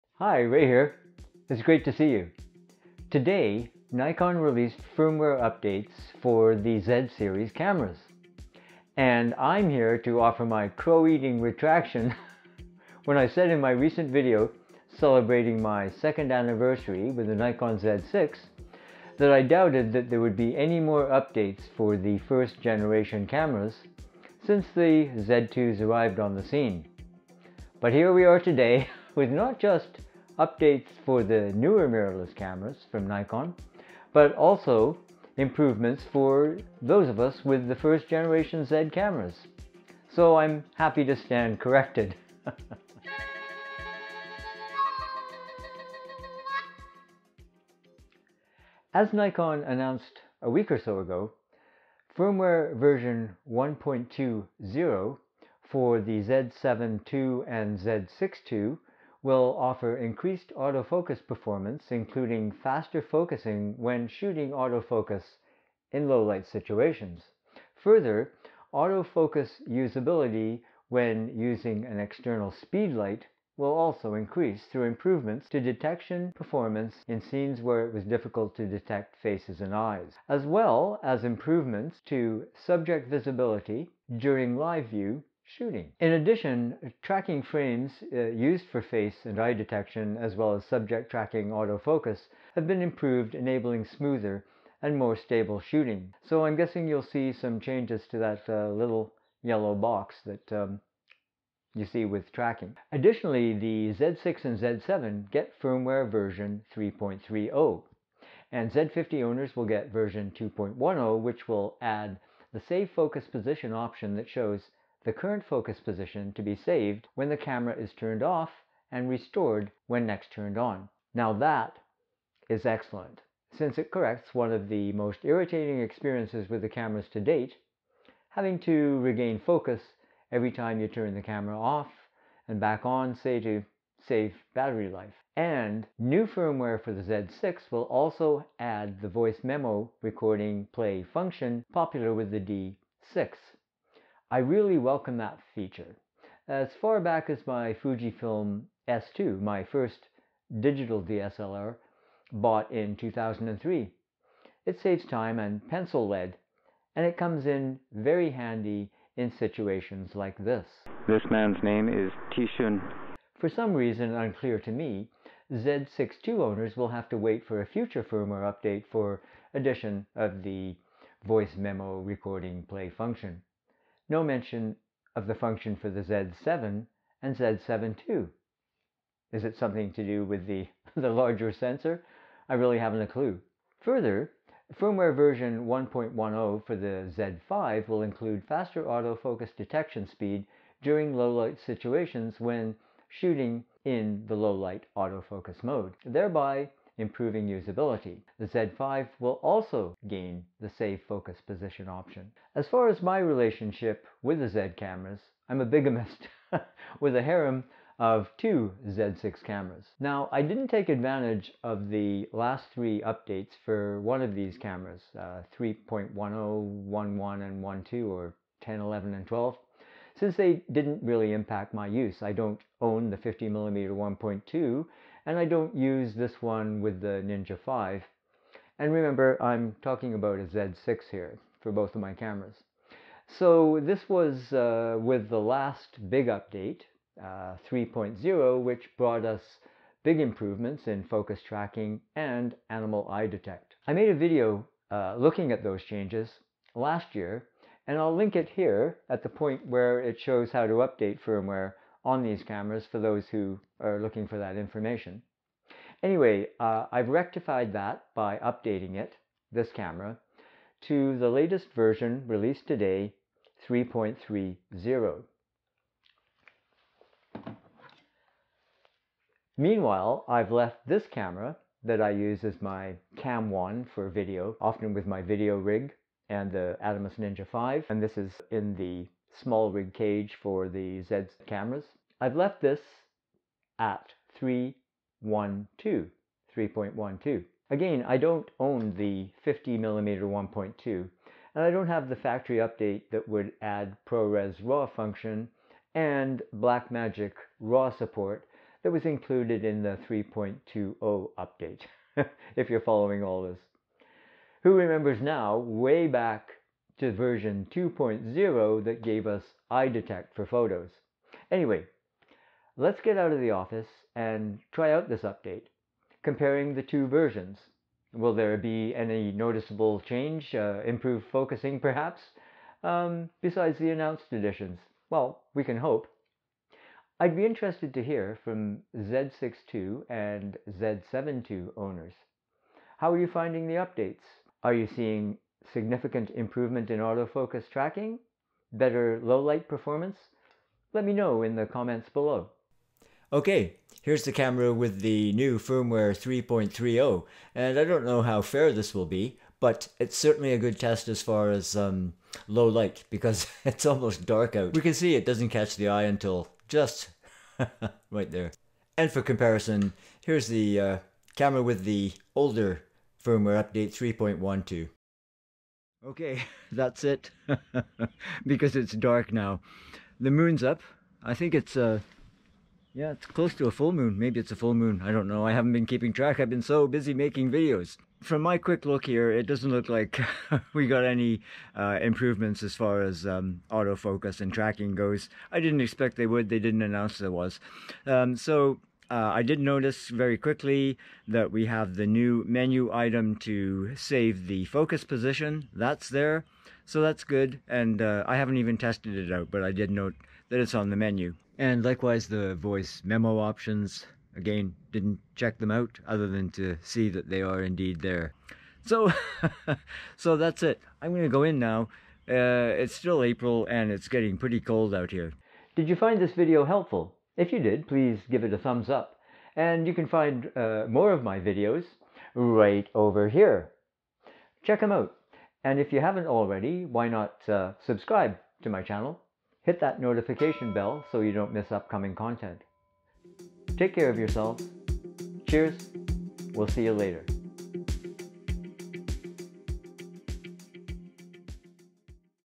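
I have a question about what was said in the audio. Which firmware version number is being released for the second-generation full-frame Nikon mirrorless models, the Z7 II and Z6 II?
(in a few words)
1.20.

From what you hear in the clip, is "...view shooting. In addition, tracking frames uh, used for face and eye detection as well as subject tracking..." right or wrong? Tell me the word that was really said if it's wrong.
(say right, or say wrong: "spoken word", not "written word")
right.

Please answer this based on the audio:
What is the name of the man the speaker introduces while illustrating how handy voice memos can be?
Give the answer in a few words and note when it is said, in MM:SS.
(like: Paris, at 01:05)
Tishun, at 02:42.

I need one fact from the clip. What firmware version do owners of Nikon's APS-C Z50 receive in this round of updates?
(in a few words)
2.10.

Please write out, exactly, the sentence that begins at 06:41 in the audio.
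And likewise, the voice memo options.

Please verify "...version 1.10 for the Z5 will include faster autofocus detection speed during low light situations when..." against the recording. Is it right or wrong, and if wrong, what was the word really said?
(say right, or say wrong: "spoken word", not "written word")
right.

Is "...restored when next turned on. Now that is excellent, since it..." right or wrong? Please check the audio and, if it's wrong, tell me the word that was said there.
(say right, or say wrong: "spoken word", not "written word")
right.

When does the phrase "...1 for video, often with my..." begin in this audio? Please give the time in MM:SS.
04:33.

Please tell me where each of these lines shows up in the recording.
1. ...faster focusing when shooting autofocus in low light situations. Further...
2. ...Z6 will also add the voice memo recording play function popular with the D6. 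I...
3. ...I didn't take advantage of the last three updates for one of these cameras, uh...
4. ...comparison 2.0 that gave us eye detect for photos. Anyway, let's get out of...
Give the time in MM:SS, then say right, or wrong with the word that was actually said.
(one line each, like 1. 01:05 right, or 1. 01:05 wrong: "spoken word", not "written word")
1. 01:02 right
2. 02:17 right
3. 03:30 right
4. 05:07 wrong: "version", not "comparison".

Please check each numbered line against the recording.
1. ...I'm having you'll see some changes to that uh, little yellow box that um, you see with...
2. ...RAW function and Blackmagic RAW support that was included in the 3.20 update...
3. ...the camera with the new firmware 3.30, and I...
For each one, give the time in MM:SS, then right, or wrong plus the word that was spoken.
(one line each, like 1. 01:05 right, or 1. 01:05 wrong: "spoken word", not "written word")
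1. 01:36 wrong: "guessing", not "having"
2. 04:54 right
3. 05:44 right.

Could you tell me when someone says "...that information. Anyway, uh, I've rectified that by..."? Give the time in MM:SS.
04:14.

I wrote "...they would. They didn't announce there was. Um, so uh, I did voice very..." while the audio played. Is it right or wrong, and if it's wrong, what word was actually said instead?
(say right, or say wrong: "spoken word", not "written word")
wrong: "notice", not "voice".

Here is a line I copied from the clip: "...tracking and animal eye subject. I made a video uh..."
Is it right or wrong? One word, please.
wrong.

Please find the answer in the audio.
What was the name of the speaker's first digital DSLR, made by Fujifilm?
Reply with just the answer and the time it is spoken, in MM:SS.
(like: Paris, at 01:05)
Fujifilm S2, at 02:27.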